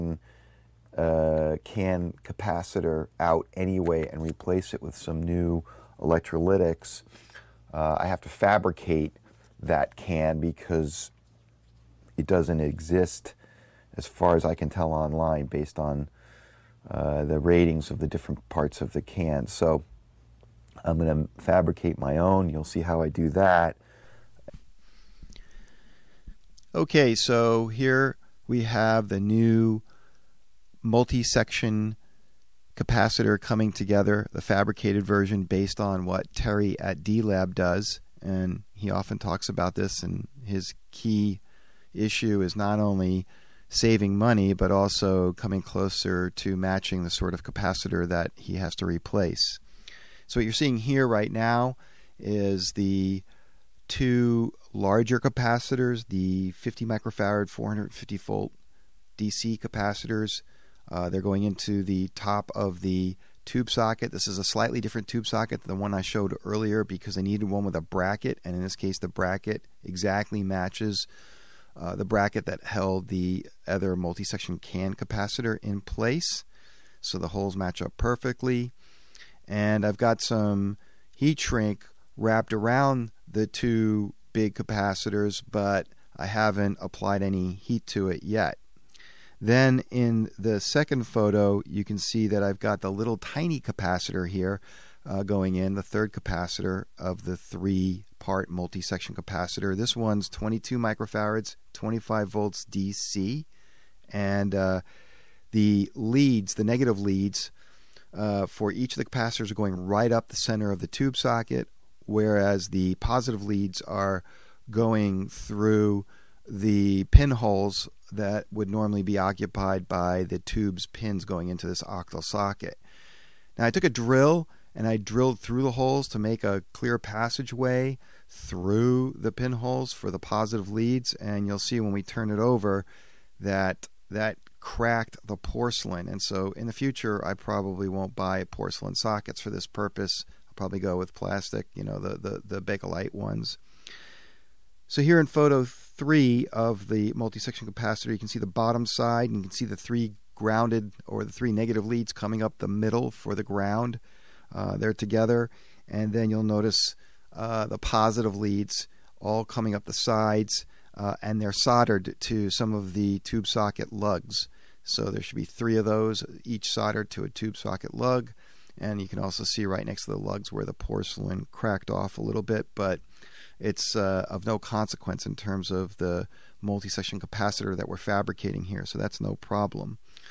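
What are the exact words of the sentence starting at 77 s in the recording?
So the holes match up perfectly.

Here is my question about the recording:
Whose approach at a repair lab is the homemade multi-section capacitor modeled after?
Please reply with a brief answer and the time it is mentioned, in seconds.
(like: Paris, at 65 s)
Terry, at 36 s.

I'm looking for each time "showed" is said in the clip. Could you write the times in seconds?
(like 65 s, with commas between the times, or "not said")
66 s.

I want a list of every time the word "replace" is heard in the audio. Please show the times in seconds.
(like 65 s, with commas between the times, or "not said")
4 s, 48 s.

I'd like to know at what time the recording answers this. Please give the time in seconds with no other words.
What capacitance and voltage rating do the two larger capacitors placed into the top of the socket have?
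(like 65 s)
56 s.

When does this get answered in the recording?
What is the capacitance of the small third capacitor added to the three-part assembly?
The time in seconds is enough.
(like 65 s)
100 s.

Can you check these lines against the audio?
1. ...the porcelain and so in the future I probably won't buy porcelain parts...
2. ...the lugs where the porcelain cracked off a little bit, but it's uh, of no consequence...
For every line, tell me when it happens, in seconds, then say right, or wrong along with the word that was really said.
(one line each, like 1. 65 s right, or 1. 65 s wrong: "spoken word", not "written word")
1. 135 s wrong: "sockets", not "parts"
2. 170 s right.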